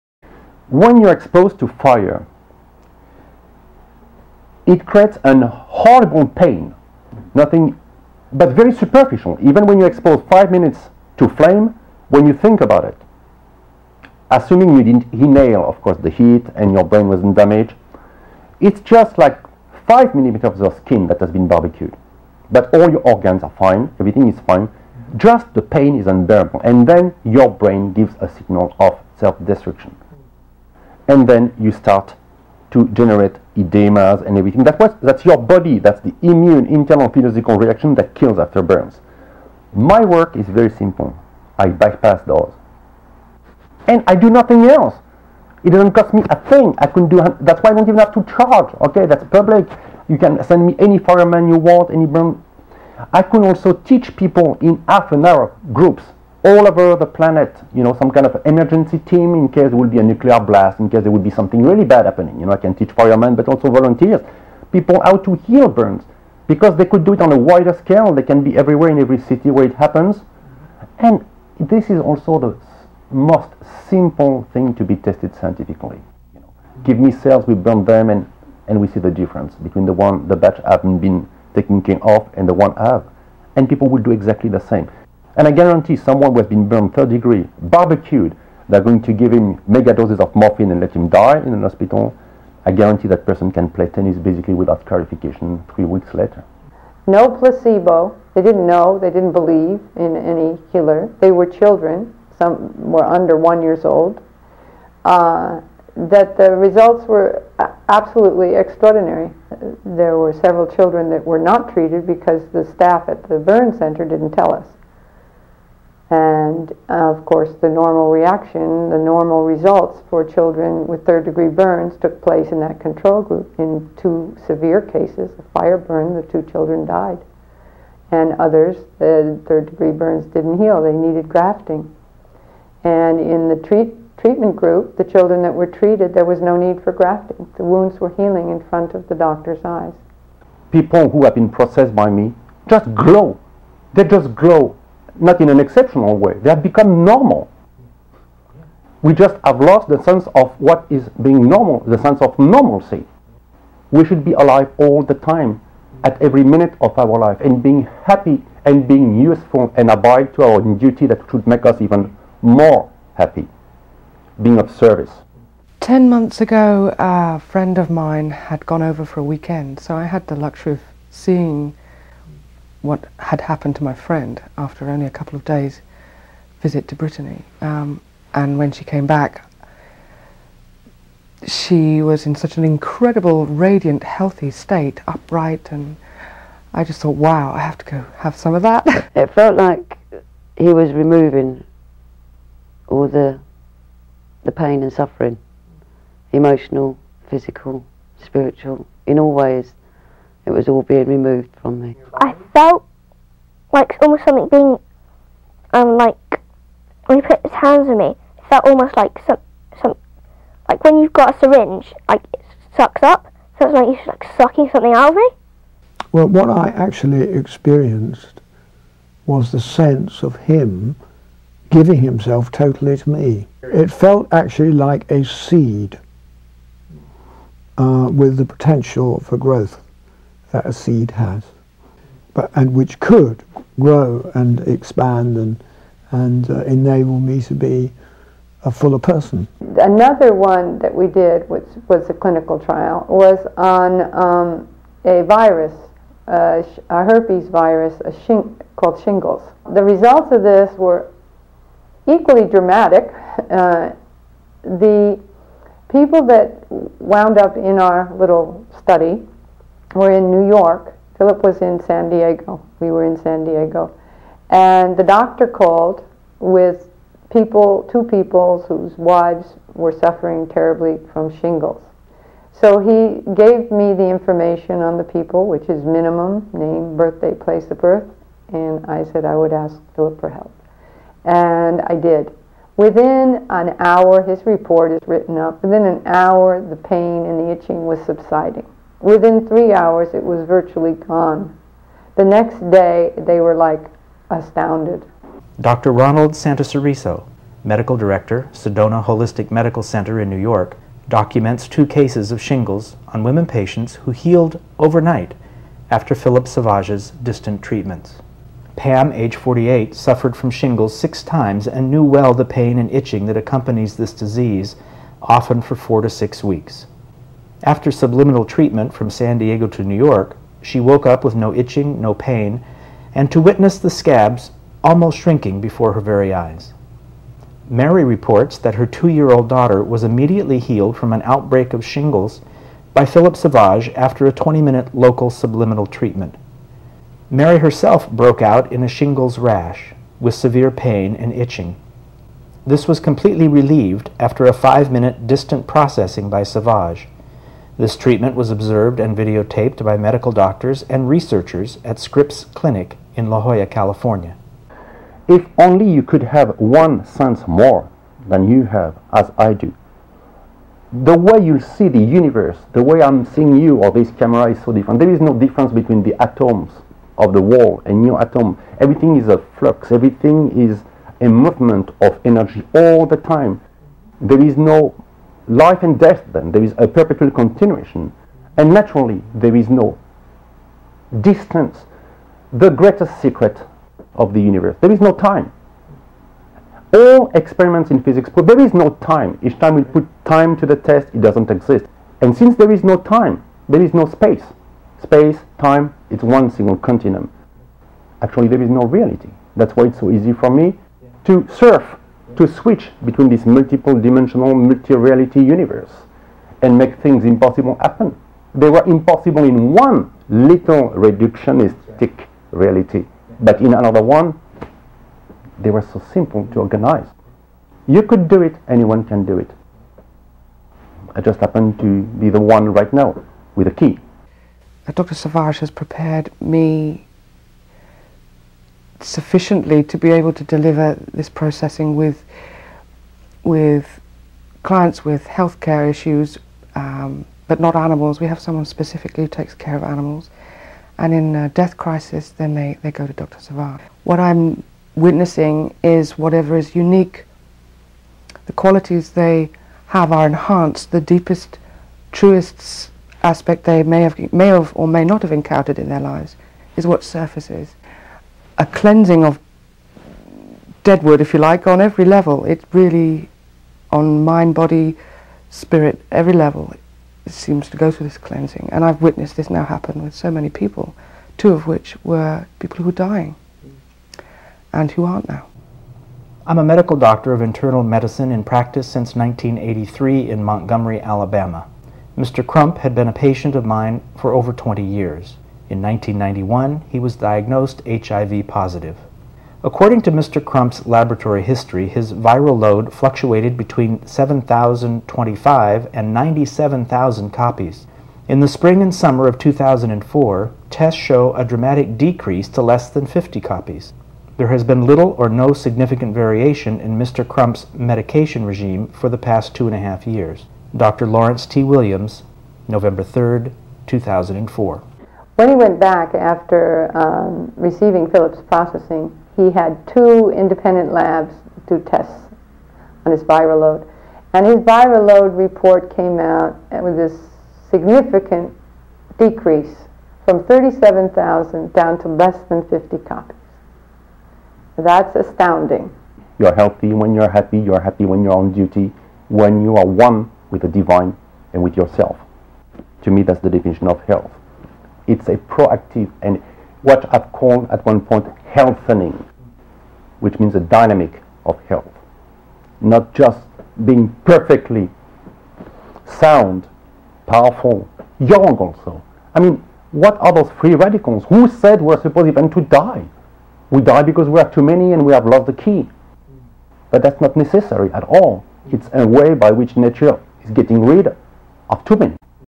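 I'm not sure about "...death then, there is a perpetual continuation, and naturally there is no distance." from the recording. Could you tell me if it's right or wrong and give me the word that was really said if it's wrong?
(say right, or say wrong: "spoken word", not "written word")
right.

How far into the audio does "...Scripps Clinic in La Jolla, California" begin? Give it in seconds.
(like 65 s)
351 s.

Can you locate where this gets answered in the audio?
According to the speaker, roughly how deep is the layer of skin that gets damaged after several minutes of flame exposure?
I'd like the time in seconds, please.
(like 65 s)
19 s.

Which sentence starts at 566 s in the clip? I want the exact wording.
But that's not necessary at all.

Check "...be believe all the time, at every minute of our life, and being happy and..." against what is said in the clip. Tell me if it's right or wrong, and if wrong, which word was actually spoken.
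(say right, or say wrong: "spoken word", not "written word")
wrong: "alive", not "believe".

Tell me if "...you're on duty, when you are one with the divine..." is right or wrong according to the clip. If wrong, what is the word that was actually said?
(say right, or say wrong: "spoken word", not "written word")
right.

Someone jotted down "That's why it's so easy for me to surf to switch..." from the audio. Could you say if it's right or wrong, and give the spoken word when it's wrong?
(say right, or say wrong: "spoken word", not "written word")
right.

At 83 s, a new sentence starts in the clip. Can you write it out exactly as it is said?
And people will do exactly the same.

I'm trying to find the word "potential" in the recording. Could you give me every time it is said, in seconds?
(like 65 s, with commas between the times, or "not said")
228 s.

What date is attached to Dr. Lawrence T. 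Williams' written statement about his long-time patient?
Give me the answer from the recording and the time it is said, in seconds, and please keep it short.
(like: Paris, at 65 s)
November 3, 2004, at 512 s.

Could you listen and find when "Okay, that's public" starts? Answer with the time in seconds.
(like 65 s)
48 s.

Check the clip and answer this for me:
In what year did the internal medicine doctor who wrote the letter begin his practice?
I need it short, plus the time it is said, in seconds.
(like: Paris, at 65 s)
1983, at 479 s.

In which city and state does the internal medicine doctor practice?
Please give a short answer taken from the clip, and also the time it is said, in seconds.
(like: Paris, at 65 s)
Montgomery, Alabama, at 480 s.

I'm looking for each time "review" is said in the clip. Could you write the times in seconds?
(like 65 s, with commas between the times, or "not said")
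not said.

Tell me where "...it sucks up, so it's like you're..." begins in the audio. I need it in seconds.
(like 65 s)
212 s.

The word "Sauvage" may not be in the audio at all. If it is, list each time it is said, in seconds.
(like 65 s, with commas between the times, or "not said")
306 s, 333 s, 346 s, 425 s, 443 s.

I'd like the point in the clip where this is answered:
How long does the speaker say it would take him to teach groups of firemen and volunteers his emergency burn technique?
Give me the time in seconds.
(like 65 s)
54 s.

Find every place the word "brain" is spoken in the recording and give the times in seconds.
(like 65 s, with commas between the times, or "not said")
16 s, 27 s.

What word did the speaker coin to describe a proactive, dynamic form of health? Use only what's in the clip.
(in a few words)
Healthening.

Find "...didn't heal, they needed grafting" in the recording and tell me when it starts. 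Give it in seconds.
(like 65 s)
130 s.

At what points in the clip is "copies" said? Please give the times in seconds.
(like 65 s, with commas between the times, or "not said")
497 s, 503 s, 532 s.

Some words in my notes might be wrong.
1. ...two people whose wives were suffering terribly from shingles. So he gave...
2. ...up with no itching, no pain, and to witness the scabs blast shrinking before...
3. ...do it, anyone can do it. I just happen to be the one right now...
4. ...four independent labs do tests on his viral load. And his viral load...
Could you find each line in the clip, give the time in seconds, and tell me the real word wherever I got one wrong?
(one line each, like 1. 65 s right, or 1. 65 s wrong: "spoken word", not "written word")
1. 267 s right
2. 321 s wrong: "almost", not "blast"
3. 418 s right
4. 519 s wrong: "two", not "four".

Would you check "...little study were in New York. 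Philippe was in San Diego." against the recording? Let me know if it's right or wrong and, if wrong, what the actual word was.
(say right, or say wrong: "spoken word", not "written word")
right.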